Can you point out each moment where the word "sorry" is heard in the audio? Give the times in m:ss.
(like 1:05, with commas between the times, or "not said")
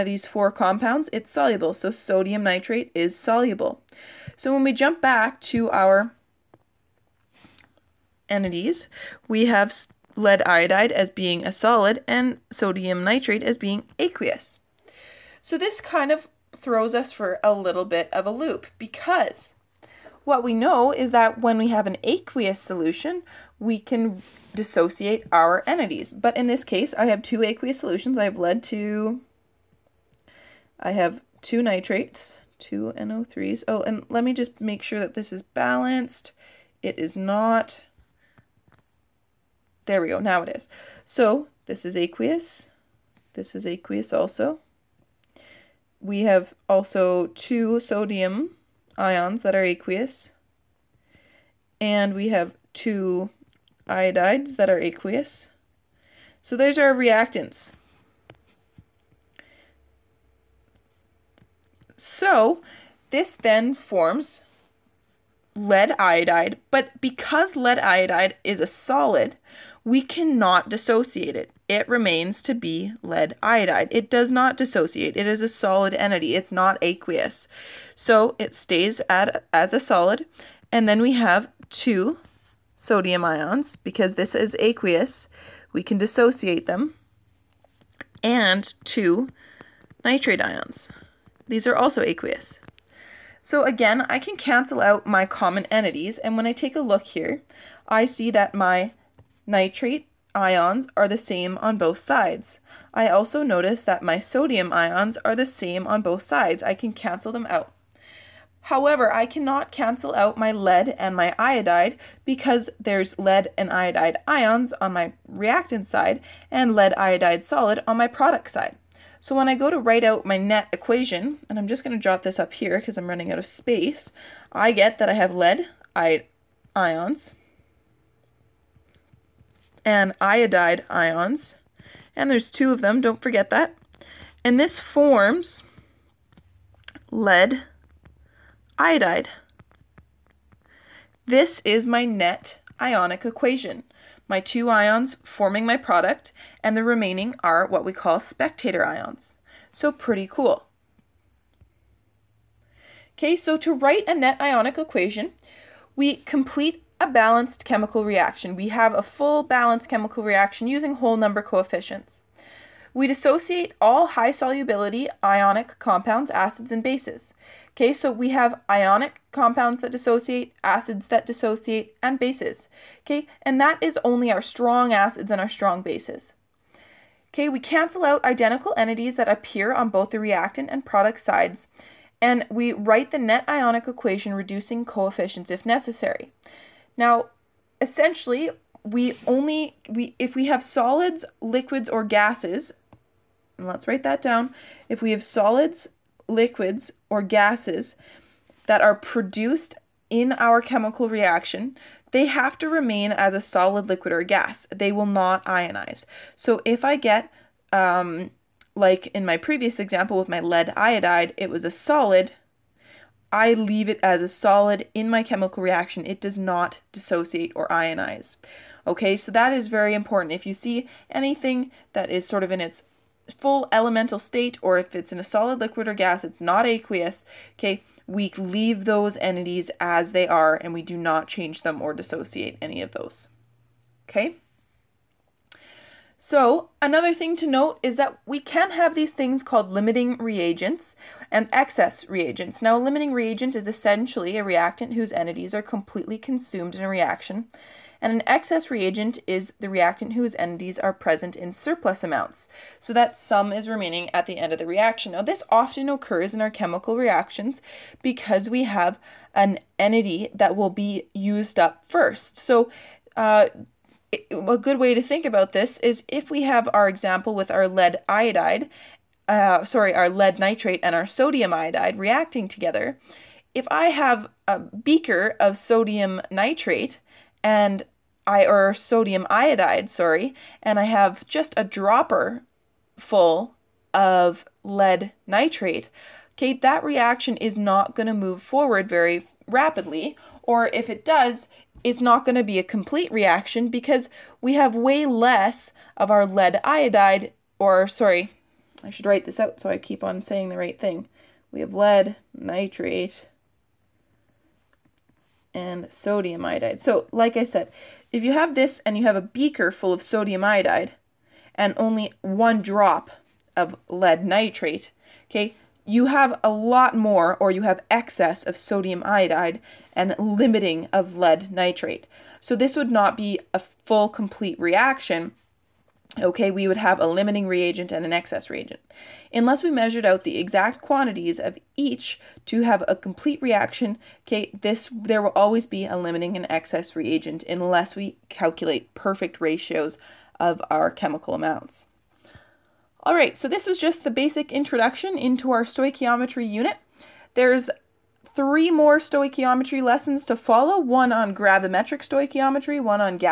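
4:29, 4:39, 4:57.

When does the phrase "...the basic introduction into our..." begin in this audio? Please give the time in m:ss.
5:44.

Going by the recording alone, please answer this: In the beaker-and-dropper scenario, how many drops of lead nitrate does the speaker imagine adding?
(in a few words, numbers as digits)
1.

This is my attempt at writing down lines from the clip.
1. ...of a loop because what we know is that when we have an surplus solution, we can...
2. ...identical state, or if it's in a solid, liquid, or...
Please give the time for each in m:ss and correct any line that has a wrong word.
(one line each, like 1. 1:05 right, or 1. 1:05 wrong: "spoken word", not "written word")
1. 0:18 wrong: "aqueous", not "surplus"
2. 3:43 wrong: "elemental", not "identical".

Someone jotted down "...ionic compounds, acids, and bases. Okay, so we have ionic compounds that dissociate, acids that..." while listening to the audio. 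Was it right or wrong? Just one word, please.
right.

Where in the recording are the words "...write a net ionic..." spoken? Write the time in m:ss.
2:33.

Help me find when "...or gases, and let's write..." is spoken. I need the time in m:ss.
3:11.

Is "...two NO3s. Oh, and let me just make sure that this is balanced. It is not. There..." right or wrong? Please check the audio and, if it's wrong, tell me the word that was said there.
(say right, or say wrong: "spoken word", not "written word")
right.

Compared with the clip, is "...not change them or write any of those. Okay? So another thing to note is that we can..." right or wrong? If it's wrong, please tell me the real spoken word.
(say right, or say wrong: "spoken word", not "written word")
wrong: "dissociate", not "write".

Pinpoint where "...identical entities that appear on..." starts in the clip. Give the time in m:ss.
2:58.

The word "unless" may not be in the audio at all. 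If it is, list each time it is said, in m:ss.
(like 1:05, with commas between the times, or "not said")
5:29, 5:37.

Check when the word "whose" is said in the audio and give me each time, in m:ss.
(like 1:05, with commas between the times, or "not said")
4:04, 4:10.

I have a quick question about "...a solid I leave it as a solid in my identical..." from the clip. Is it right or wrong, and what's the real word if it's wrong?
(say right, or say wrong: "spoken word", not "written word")
wrong: "chemical", not "identical".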